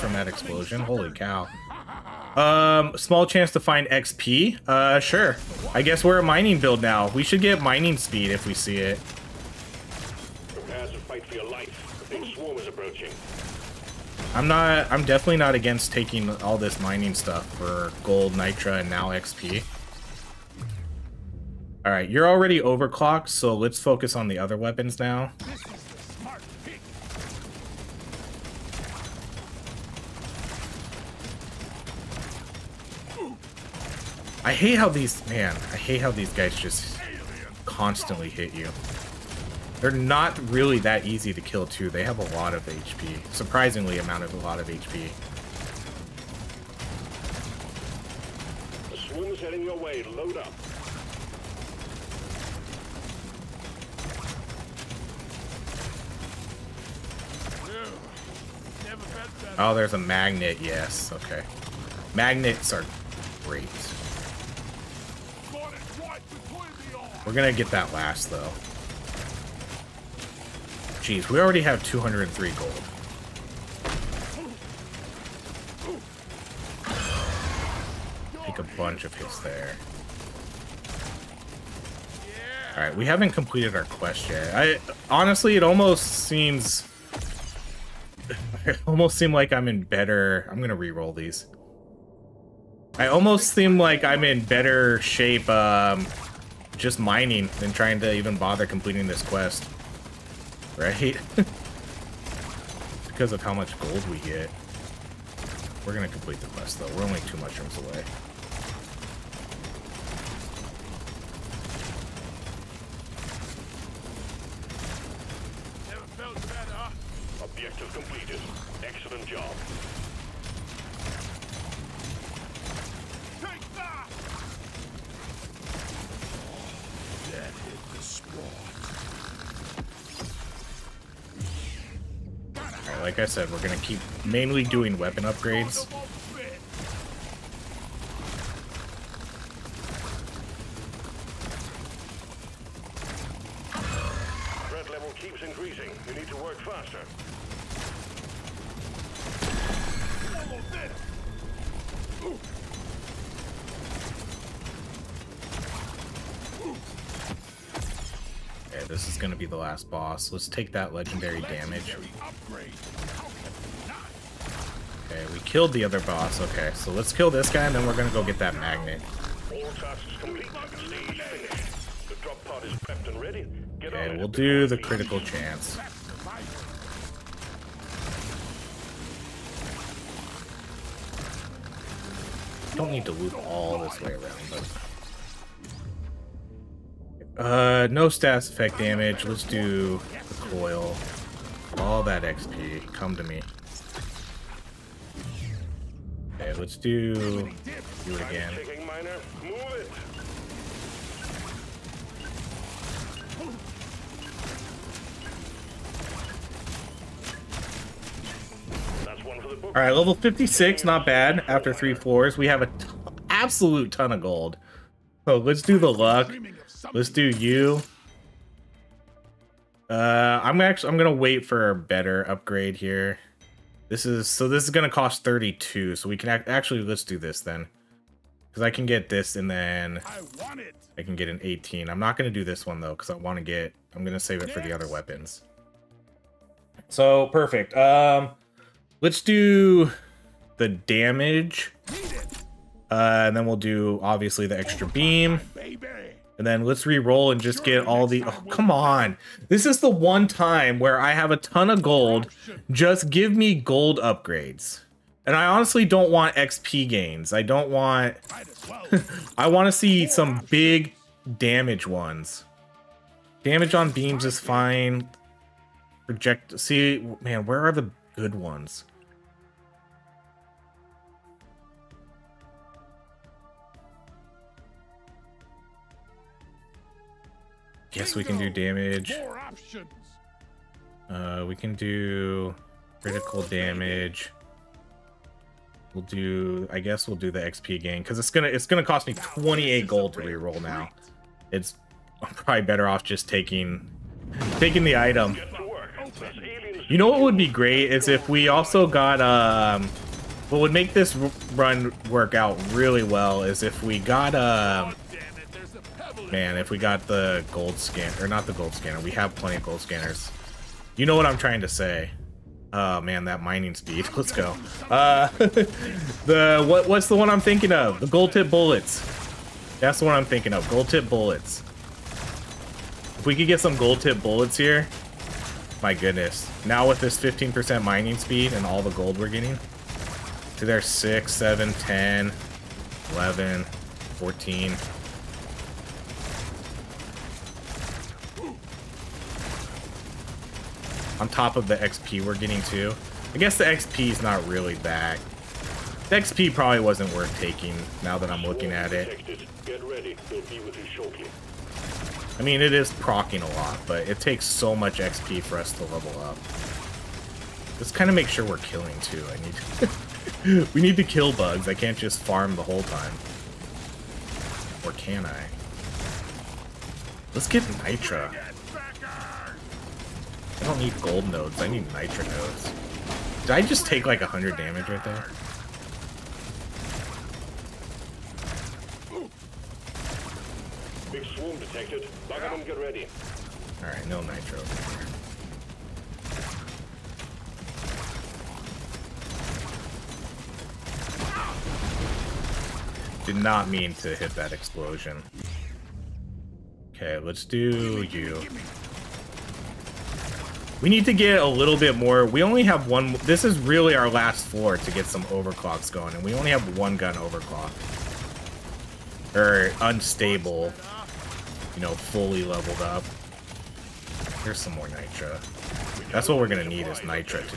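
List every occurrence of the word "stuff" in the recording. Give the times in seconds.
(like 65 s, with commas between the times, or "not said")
17 s.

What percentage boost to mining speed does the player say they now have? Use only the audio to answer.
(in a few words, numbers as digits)
15%.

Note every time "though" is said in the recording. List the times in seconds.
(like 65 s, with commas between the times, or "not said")
68 s, 106 s, 232 s.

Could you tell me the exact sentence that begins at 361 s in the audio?
I can't just farm the whole time.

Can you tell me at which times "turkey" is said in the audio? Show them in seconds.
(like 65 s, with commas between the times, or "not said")
not said.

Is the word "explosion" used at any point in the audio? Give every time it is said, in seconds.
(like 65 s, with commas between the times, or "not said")
0 s, 394 s.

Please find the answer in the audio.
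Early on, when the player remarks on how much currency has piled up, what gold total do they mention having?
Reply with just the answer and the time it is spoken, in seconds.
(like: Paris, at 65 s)
203, at 71 s.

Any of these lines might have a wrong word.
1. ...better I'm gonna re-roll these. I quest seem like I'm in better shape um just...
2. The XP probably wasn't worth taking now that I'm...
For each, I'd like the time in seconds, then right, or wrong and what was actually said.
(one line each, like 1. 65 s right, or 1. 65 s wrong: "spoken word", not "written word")
1. 89 s wrong: "almost", not "quest"
2. 346 s right.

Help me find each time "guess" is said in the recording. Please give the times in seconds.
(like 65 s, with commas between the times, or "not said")
5 s, 286 s, 343 s.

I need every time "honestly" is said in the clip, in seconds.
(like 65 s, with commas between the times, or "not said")
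85 s, 255 s.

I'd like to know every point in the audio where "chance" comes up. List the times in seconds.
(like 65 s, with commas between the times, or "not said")
3 s, 175 s.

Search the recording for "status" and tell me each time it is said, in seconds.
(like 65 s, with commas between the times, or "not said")
188 s.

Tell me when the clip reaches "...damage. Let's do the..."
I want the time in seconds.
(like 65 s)
188 s.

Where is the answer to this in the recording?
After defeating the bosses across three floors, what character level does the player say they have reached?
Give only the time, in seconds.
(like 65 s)
209 s.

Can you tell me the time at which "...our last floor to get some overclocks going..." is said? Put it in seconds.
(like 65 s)
403 s.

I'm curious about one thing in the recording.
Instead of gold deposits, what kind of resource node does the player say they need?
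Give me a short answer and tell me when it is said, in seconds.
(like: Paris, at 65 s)
Nitra nodes, at 371 s.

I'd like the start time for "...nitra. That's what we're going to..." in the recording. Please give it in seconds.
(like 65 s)
414 s.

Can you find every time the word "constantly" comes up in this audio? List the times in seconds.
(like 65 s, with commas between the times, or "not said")
37 s.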